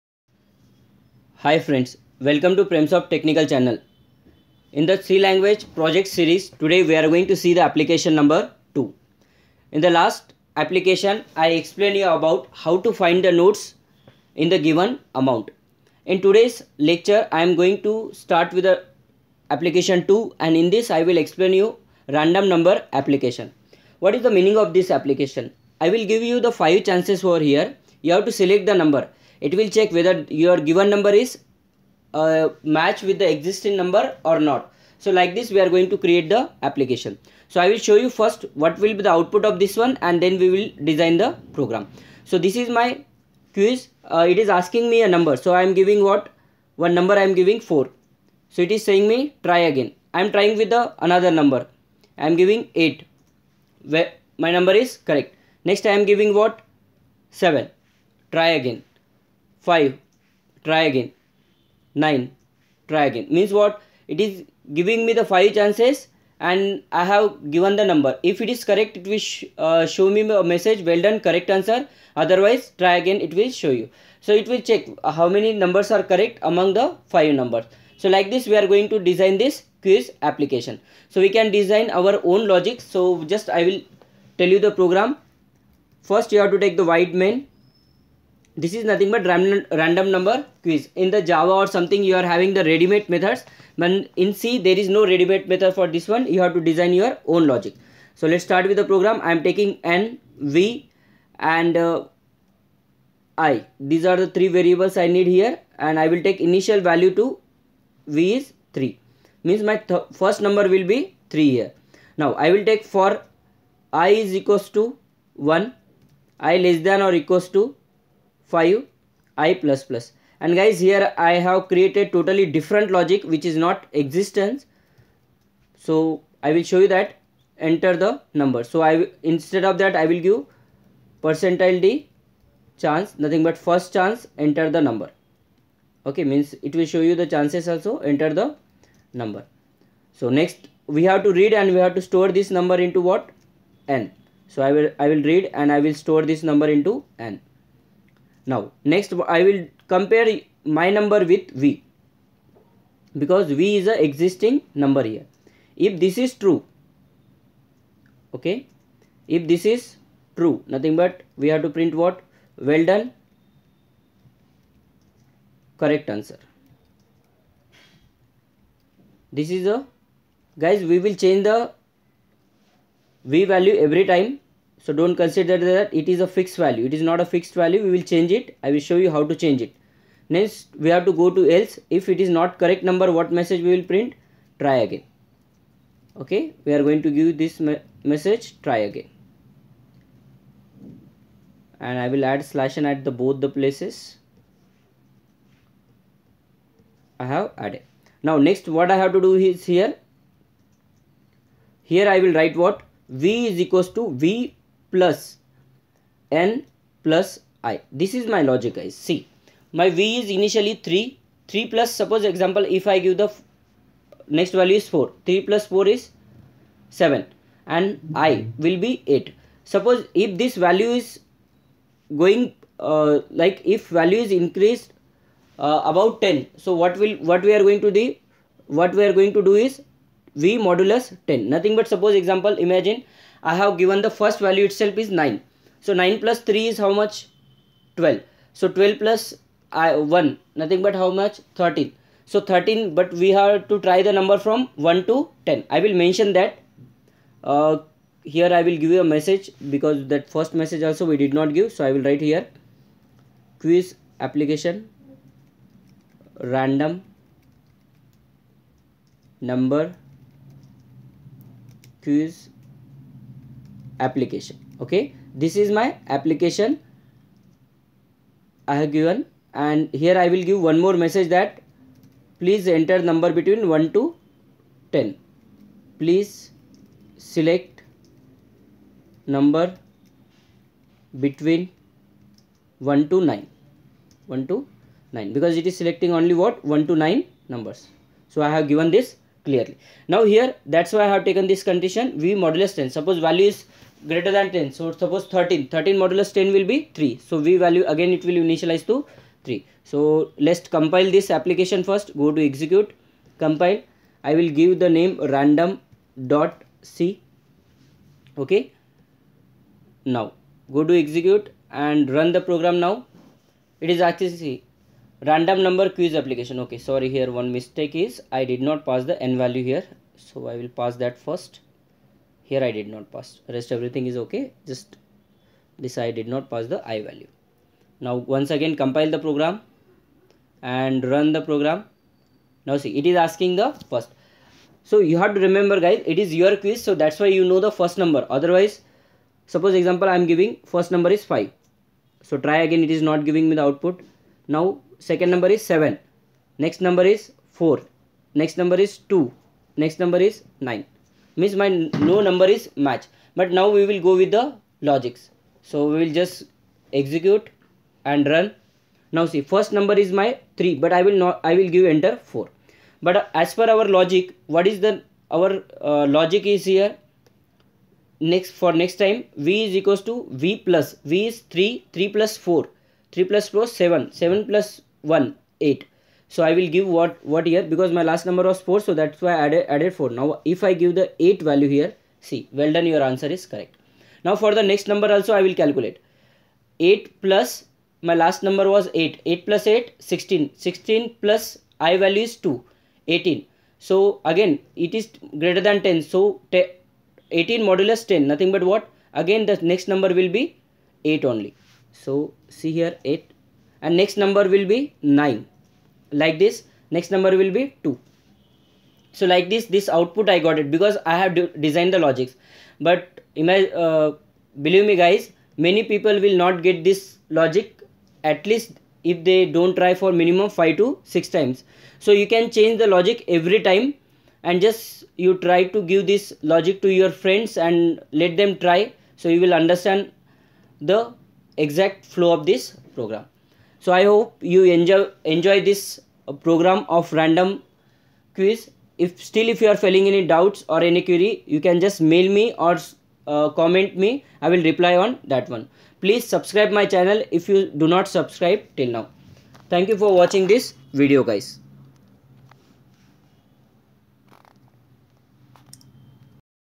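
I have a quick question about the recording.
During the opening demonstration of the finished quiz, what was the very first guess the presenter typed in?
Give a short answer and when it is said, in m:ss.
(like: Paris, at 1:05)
4, at 0:47.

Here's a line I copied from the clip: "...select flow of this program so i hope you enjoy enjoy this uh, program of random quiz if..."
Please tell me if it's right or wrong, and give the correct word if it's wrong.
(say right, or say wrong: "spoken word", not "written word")
wrong: "exact", not "select".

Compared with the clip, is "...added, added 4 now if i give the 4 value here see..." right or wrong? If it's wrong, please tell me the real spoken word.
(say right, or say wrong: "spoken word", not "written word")
wrong: "8", not "4".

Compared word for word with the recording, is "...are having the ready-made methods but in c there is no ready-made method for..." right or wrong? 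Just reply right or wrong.
right.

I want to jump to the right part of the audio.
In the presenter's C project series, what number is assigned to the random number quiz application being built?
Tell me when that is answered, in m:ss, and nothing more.
0:07.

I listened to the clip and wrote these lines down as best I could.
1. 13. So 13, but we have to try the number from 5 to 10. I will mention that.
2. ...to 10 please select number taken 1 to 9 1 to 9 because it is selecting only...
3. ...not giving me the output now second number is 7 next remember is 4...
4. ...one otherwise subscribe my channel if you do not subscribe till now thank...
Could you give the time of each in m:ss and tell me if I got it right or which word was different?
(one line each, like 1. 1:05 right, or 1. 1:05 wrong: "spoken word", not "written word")
1. 4:01 wrong: "1", not "5"
2. 4:33 wrong: "between", not "taken"
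3. 5:43 wrong: "number", not "remember"
4. 7:25 wrong: "please", not "otherwise".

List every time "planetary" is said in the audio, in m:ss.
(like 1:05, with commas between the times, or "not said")
not said.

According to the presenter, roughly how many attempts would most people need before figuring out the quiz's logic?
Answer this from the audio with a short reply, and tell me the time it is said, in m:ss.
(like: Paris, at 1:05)
5 to 6, at 7:00.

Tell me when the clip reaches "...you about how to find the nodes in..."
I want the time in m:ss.
0:11.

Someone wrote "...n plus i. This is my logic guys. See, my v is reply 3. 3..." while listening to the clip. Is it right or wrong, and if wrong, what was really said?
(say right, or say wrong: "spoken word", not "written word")
wrong: "initially", not "reply".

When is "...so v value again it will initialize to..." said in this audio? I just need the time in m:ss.
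4:57.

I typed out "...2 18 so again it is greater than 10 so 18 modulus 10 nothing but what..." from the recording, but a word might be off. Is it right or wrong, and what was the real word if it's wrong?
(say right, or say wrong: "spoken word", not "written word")
right.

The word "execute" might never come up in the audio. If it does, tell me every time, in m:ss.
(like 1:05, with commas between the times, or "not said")
5:02, 5:11, 5:56.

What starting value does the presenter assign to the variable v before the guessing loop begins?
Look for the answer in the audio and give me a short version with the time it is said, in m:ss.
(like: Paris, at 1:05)
3, at 1:46.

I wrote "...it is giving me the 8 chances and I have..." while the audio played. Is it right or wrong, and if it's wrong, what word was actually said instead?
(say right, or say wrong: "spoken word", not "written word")
wrong: "5", not "8".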